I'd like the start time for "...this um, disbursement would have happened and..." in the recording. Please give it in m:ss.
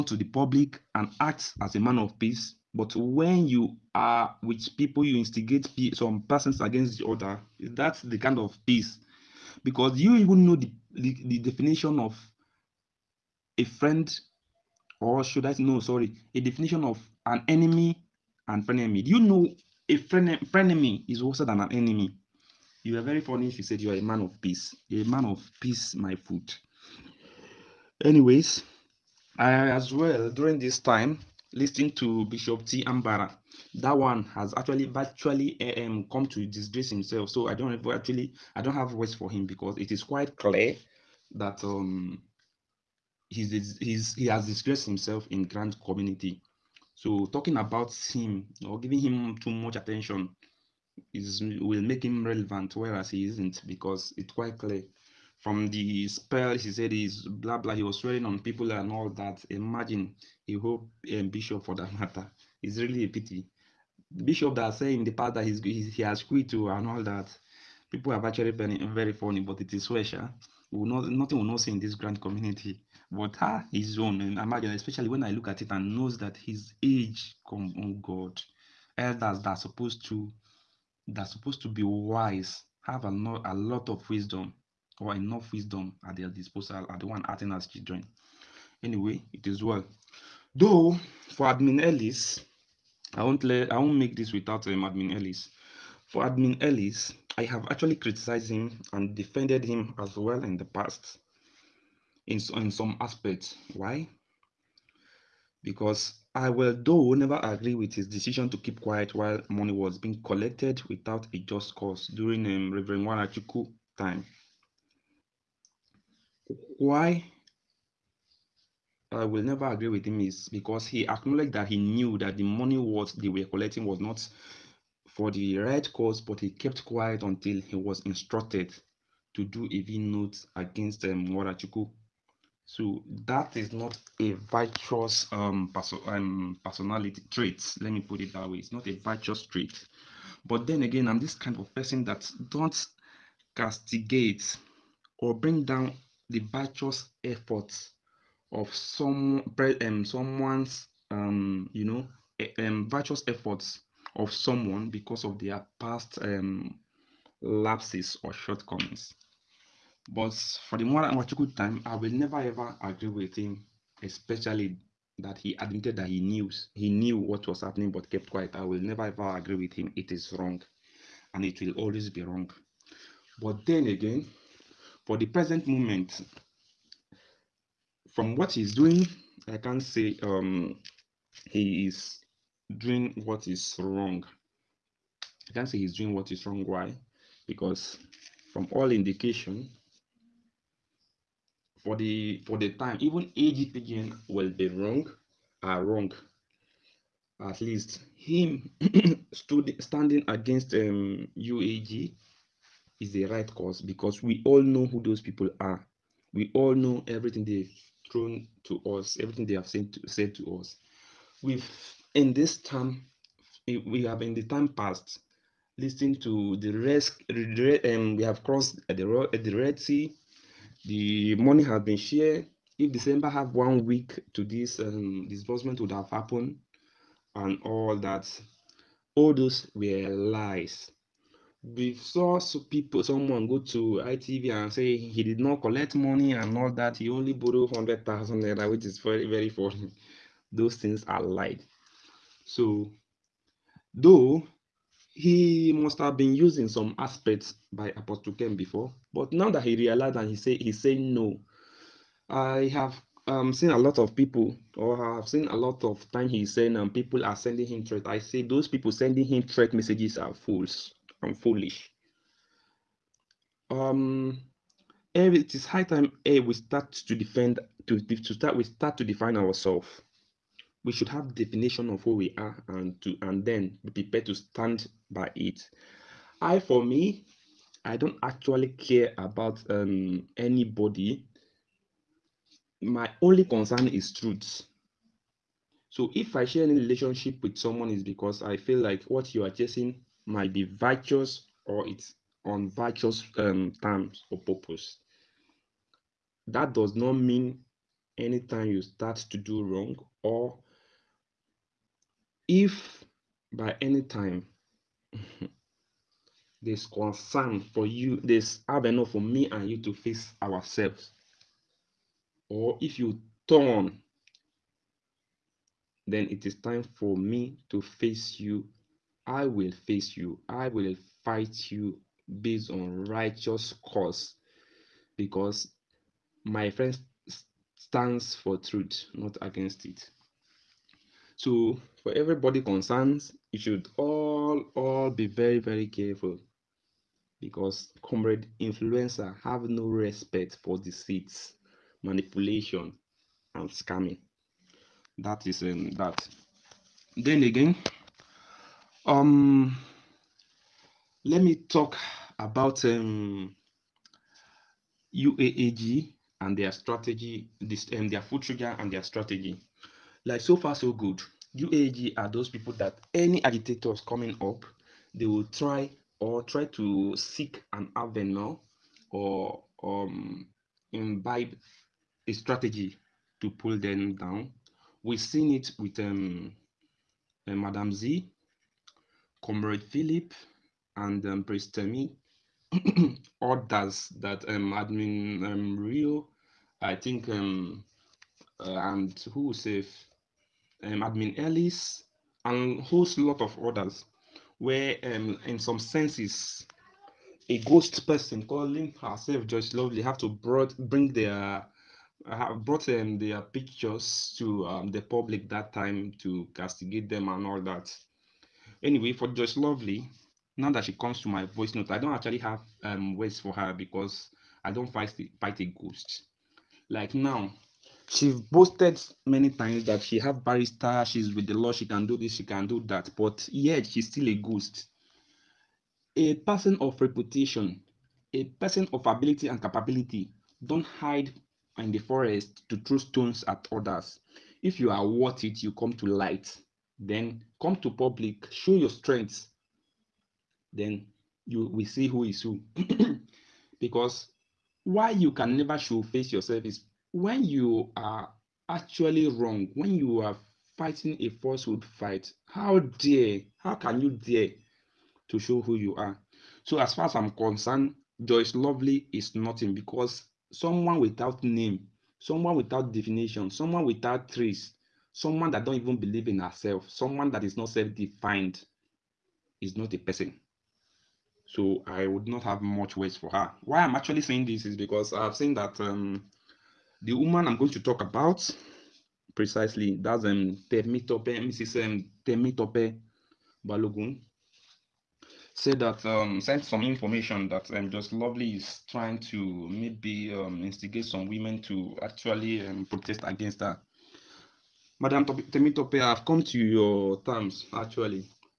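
3:44.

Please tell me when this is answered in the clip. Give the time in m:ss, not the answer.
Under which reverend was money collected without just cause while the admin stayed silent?
1:52.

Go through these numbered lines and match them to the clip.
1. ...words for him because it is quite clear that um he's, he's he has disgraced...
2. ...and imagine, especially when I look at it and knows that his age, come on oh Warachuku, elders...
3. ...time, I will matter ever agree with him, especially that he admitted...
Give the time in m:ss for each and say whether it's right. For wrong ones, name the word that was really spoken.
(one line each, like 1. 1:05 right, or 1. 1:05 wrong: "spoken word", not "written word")
1. 0:38 right
2. 1:14 wrong: "God", not "Warachuku"
3. 2:41 wrong: "never", not "matter".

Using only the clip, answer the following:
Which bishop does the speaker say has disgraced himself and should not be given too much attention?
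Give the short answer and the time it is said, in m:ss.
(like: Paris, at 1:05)
Bishop T. Ambara, at 0:32.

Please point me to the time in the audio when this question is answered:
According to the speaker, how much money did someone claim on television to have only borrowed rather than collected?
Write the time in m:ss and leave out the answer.
3:57.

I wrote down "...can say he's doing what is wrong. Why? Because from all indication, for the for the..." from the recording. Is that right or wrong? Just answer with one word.
right.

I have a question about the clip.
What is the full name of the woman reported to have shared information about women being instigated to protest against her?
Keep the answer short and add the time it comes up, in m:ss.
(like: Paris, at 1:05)
Temitope Balogun, at 8:02.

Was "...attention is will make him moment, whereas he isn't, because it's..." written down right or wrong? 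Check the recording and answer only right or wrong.
wrong.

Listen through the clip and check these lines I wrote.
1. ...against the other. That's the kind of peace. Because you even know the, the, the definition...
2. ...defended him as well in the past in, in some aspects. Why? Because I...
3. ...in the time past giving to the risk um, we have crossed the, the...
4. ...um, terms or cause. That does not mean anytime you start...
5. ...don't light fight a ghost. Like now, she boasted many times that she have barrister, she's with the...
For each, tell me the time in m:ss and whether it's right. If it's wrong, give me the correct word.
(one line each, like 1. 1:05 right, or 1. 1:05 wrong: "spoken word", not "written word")
1. 0:06 right
2. 1:39 right
3. 3:34 wrong: "listening", not "giving"
4. 4:53 wrong: "purpose", not "cause"
5. 6:54 wrong: "fight", not "light".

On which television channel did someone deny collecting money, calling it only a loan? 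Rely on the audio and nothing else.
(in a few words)
ITV.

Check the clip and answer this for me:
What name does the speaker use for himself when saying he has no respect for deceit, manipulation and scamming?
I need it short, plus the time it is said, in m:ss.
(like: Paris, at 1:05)
Comrade influencer, at 5:38.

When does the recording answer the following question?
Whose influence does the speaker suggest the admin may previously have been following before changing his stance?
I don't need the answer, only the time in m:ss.
4:07.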